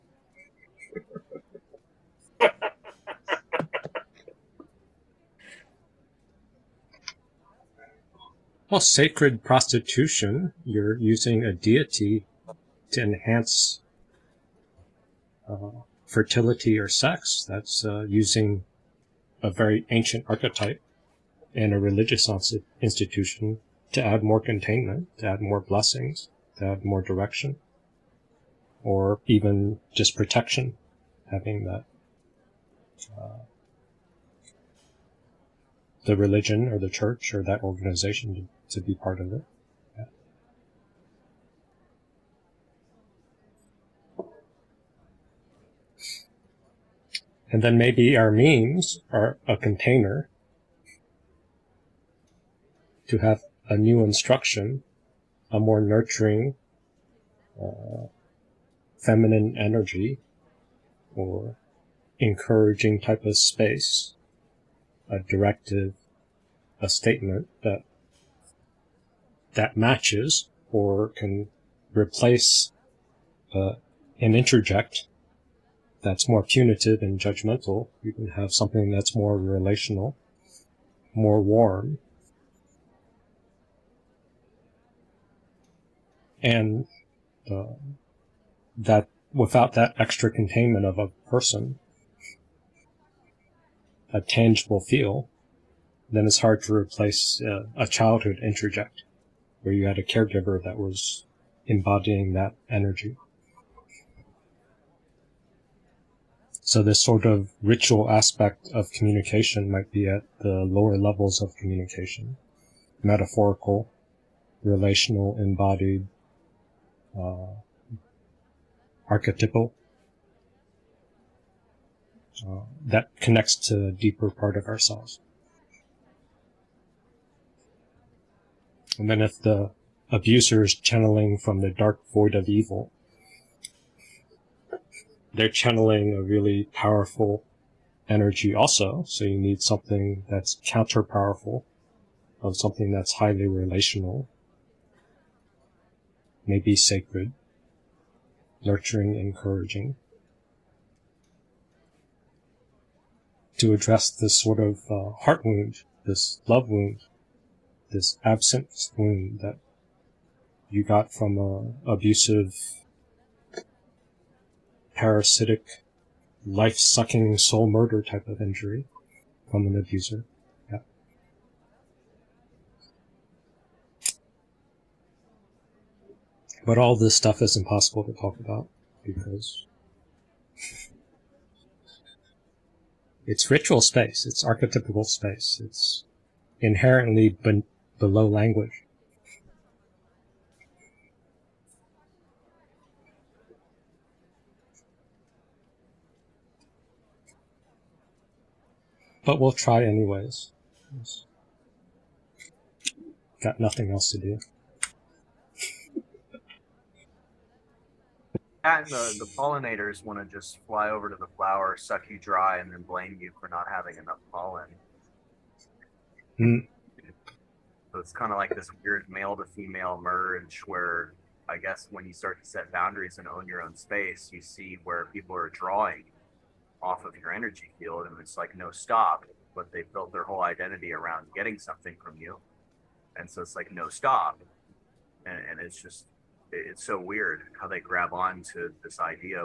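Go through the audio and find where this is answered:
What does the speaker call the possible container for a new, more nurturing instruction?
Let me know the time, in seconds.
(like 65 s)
48 s.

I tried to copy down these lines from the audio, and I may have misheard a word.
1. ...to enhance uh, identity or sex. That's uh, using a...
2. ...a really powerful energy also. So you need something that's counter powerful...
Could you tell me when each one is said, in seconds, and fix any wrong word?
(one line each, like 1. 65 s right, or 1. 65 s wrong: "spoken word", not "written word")
1. 12 s wrong: "fertility", not "identity"
2. 136 s right.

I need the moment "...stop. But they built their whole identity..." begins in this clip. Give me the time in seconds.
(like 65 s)
228 s.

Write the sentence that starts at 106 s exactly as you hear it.
So this sort of ritual aspect of communication might be at the lower levels of communication, metaphorical, relational, embodied, uh, archetypal.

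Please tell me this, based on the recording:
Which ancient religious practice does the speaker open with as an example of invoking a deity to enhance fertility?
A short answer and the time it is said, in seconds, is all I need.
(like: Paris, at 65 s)
Sacred prostitution, at 8 s.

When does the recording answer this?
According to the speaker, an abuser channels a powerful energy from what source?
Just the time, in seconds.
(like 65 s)
131 s.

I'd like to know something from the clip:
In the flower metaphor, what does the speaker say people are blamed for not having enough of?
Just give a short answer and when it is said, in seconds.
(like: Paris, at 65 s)
Pollen, at 214 s.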